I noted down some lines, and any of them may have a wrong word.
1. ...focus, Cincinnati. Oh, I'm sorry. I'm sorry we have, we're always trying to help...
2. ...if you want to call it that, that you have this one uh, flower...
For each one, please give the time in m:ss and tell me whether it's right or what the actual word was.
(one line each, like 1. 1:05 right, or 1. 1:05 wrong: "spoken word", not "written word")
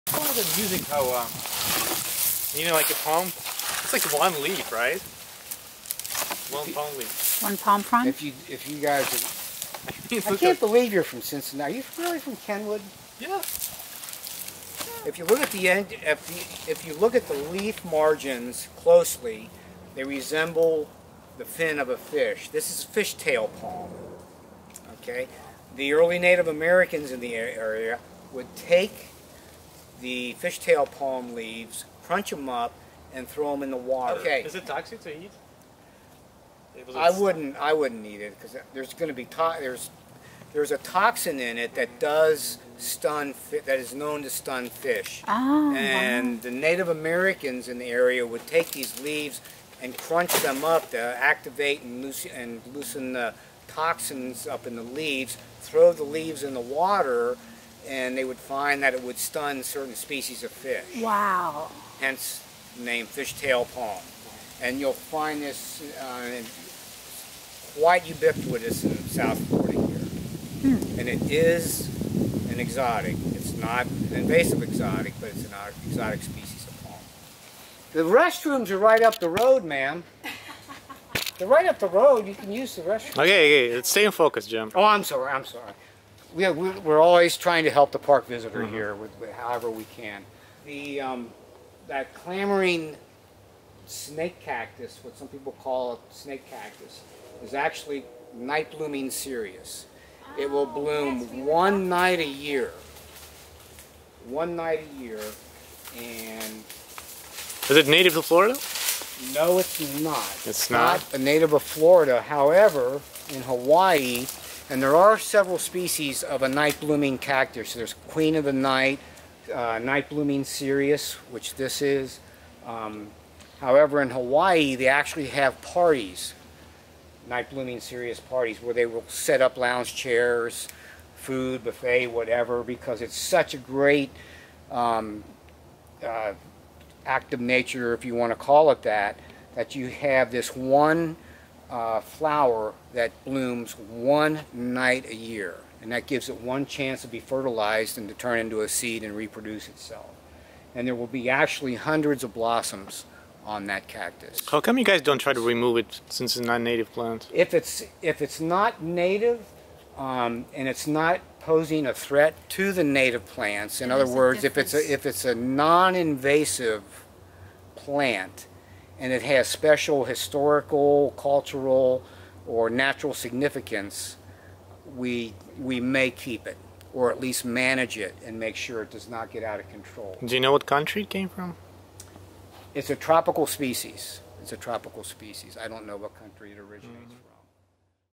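1. 1:24 wrong: "Jim", not "Cincinnati"
2. 2:17 right.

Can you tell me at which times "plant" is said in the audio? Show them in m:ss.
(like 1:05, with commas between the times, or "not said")
2:36, 2:43, 2:47.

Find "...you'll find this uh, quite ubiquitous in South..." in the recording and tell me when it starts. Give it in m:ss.
1:04.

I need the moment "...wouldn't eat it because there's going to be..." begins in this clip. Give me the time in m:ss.
0:37.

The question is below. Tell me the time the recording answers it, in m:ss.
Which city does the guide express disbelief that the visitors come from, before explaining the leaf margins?
0:11.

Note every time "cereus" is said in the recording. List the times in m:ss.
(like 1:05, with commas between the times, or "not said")
1:39, 2:00, 2:07.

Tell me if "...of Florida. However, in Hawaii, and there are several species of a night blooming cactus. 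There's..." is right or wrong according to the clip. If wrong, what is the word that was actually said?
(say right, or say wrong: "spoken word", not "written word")
right.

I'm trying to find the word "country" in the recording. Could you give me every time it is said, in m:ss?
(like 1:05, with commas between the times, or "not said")
3:00, 3:06.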